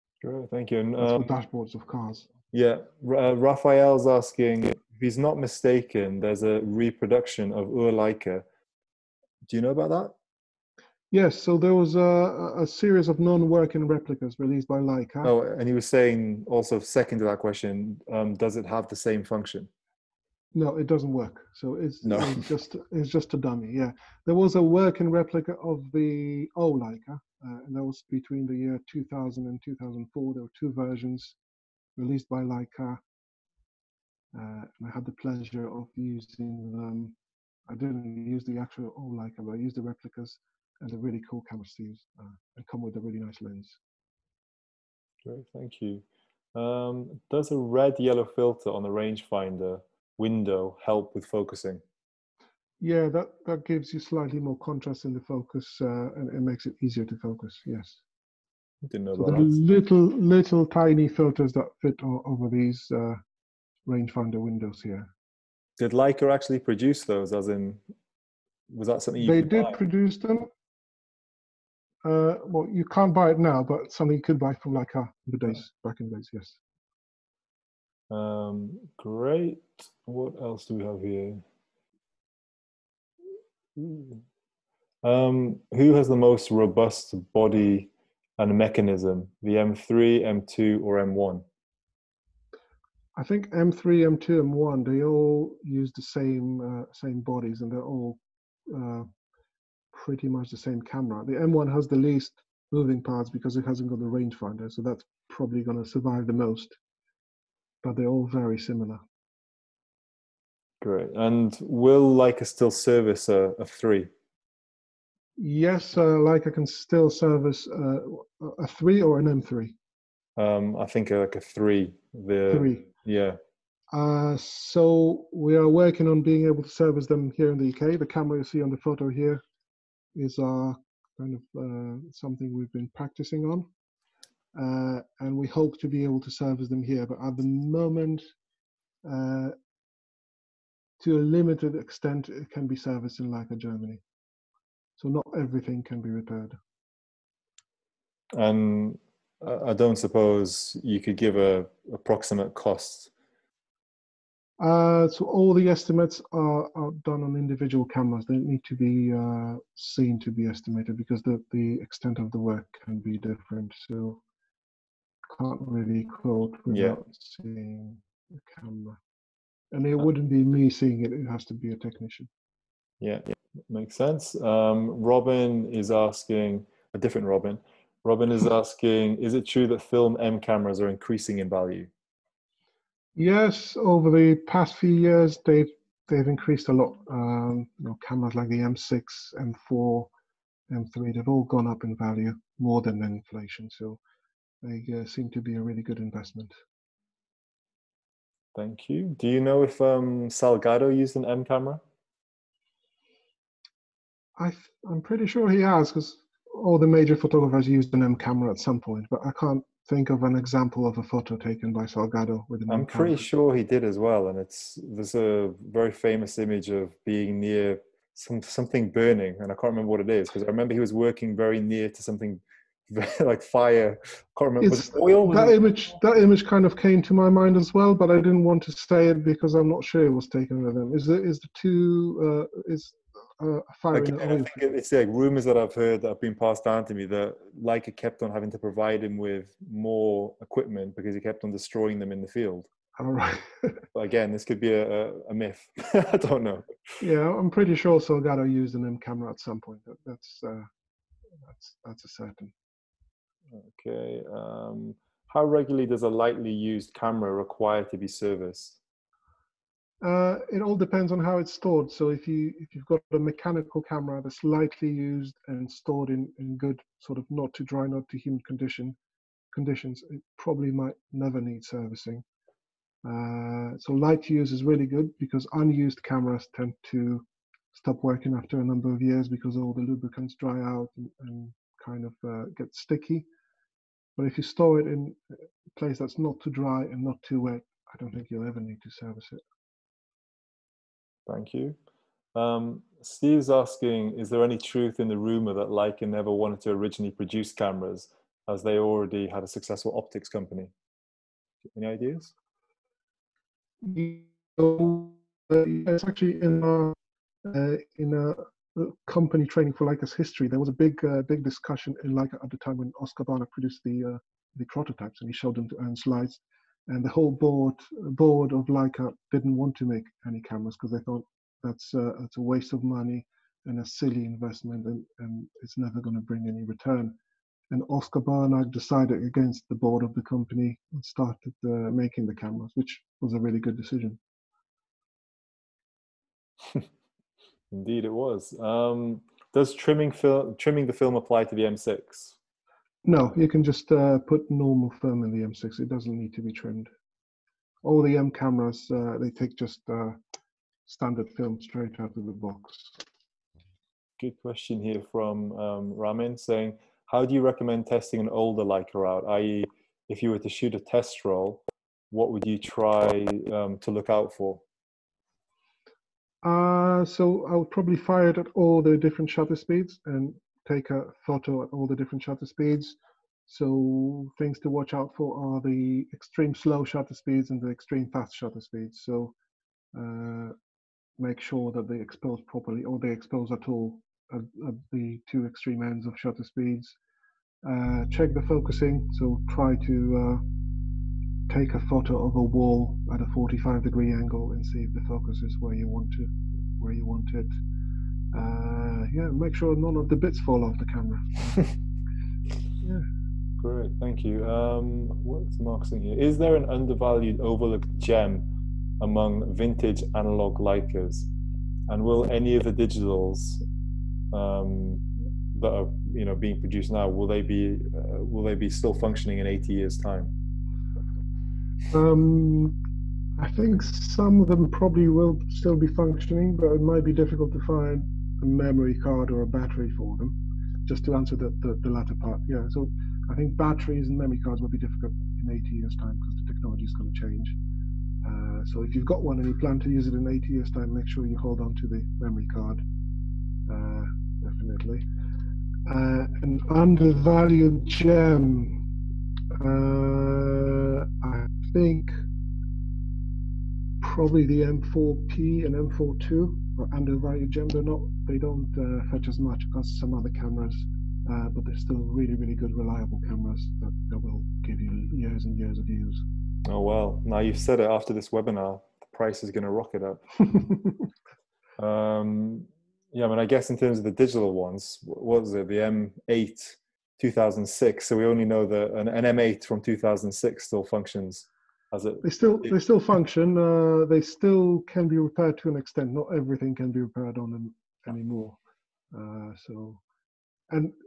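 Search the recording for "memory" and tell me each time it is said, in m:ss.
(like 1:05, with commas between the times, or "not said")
7:08, 7:14, 7:22.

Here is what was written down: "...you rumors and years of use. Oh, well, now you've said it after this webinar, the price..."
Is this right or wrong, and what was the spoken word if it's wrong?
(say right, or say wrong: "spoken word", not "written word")
wrong: "years", not "rumors".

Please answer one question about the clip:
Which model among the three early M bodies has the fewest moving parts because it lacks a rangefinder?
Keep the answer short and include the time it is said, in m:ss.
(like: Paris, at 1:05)
M1, at 1:41.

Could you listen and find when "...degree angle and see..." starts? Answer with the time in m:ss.
6:33.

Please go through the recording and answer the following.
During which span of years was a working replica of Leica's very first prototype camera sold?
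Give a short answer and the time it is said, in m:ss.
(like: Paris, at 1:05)
2000 to 2004, at 0:28.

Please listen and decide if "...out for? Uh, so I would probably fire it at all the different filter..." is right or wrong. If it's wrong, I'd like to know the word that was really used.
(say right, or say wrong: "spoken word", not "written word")
wrong: "shutter", not "filter".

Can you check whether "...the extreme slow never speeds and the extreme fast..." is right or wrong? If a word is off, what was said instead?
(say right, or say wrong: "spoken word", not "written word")
wrong: "shutter", not "never".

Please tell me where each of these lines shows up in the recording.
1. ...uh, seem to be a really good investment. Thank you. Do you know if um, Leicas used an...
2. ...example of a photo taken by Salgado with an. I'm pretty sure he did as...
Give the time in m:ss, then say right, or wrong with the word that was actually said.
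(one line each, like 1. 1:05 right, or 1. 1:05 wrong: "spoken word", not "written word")
1. 3:14 wrong: "Salgado", not "Leicas"
2. 3:30 right.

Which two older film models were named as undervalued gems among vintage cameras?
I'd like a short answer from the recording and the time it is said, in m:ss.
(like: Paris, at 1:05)
M4P and M4-2, at 7:34.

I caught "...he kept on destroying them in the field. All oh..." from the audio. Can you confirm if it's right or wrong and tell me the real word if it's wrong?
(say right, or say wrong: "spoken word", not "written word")
right.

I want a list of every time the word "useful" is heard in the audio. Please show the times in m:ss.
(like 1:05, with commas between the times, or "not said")
not said.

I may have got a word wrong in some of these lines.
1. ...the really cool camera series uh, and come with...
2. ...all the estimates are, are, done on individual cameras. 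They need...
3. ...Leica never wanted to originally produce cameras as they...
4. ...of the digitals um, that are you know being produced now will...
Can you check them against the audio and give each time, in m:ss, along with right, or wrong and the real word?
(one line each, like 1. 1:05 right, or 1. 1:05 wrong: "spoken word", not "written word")
1. 0:40 wrong: "sleeves", not "series"
2. 2:35 right
3. 4:55 right
4. 6:52 right.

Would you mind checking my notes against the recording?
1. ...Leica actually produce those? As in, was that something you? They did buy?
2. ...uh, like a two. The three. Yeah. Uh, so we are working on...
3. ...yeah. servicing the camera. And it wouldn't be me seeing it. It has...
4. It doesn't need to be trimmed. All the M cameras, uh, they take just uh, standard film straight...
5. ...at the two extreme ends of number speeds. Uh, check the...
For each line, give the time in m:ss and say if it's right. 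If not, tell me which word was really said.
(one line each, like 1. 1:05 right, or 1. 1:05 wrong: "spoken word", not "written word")
1. 1:05 right
2. 2:01 wrong: "three", not "two"
3. 2:47 wrong: "seeing", not "servicing"
4. 5:45 right
5. 6:24 wrong: "shutter", not "number".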